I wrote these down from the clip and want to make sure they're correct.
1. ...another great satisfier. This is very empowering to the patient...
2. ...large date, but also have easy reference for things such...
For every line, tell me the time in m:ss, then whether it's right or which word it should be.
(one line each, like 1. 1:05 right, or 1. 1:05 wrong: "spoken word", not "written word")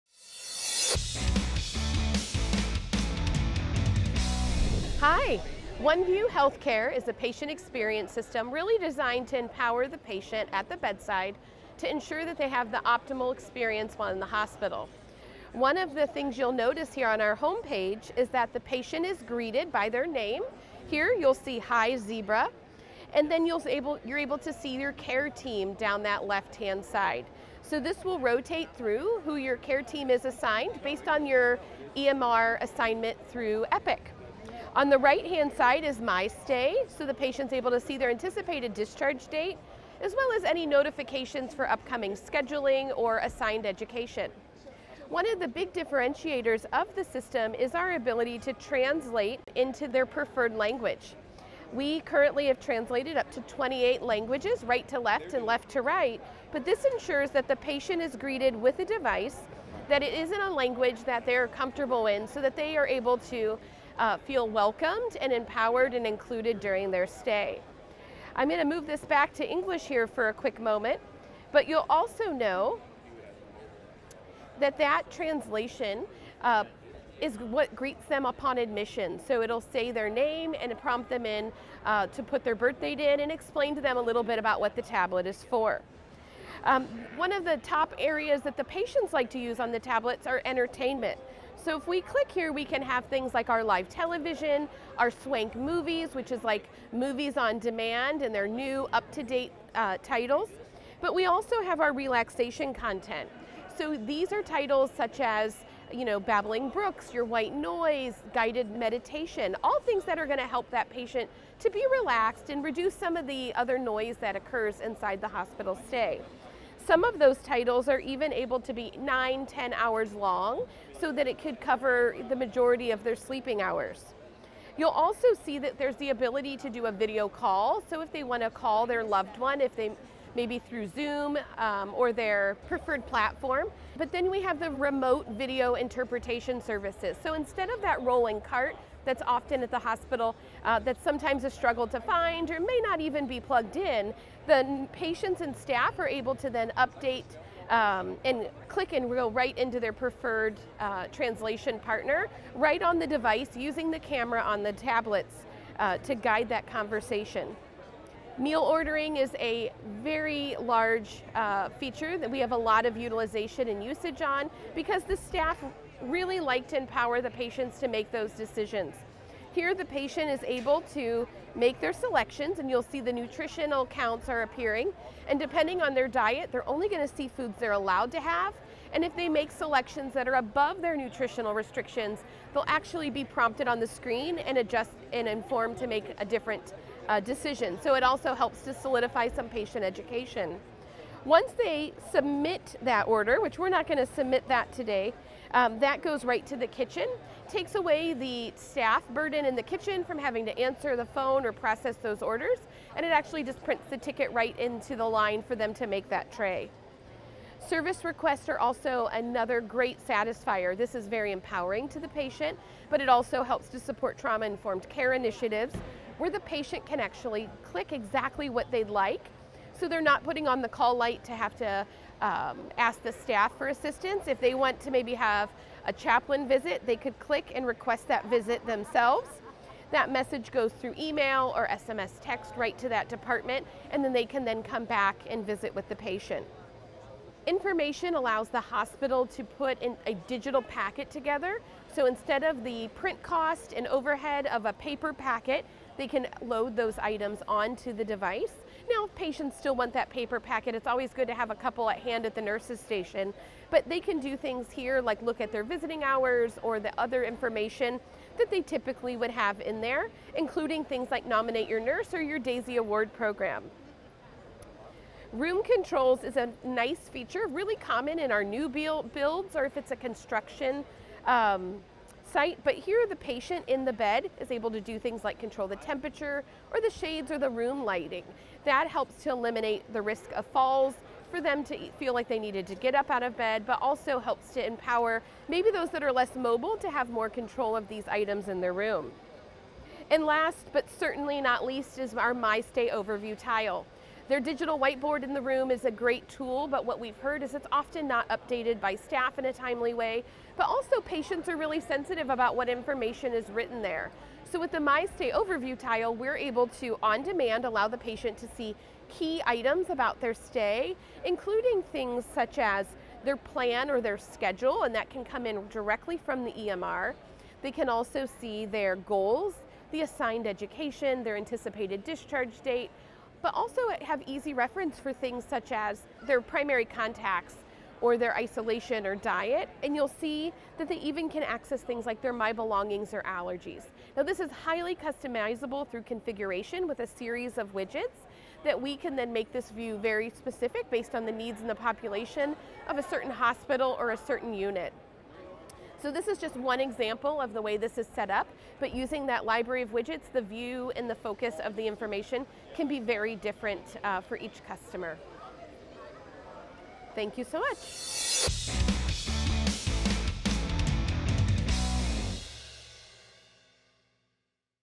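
1. 3:29 right
2. 5:22 wrong: "discharge", not "large".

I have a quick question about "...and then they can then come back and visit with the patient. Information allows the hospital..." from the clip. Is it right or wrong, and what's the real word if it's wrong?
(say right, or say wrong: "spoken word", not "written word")
right.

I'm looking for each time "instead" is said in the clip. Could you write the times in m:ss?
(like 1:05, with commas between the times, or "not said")
2:17, 4:02.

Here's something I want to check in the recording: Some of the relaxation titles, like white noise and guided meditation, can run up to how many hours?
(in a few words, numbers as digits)
10 hours.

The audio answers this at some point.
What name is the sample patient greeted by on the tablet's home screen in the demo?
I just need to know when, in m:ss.
0:21.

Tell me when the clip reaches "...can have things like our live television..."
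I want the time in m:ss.
1:32.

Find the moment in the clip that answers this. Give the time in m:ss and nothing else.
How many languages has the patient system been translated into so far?
0:53.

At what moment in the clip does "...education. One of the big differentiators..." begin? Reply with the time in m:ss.
0:43.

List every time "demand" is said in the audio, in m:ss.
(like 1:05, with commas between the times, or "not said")
1:37, 5:07.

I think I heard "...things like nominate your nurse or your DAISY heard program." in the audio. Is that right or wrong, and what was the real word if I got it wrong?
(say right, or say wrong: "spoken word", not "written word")
wrong: "award", not "heard".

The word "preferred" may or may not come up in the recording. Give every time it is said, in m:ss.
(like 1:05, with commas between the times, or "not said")
0:50, 2:12, 2:29.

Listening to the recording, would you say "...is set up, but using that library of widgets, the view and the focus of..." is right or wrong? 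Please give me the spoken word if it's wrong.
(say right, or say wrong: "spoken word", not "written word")
right.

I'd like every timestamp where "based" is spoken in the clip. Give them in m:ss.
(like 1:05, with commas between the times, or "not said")
0:30, 5:40.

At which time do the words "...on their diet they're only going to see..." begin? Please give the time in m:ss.
2:55.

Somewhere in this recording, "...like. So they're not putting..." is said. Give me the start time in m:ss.
3:38.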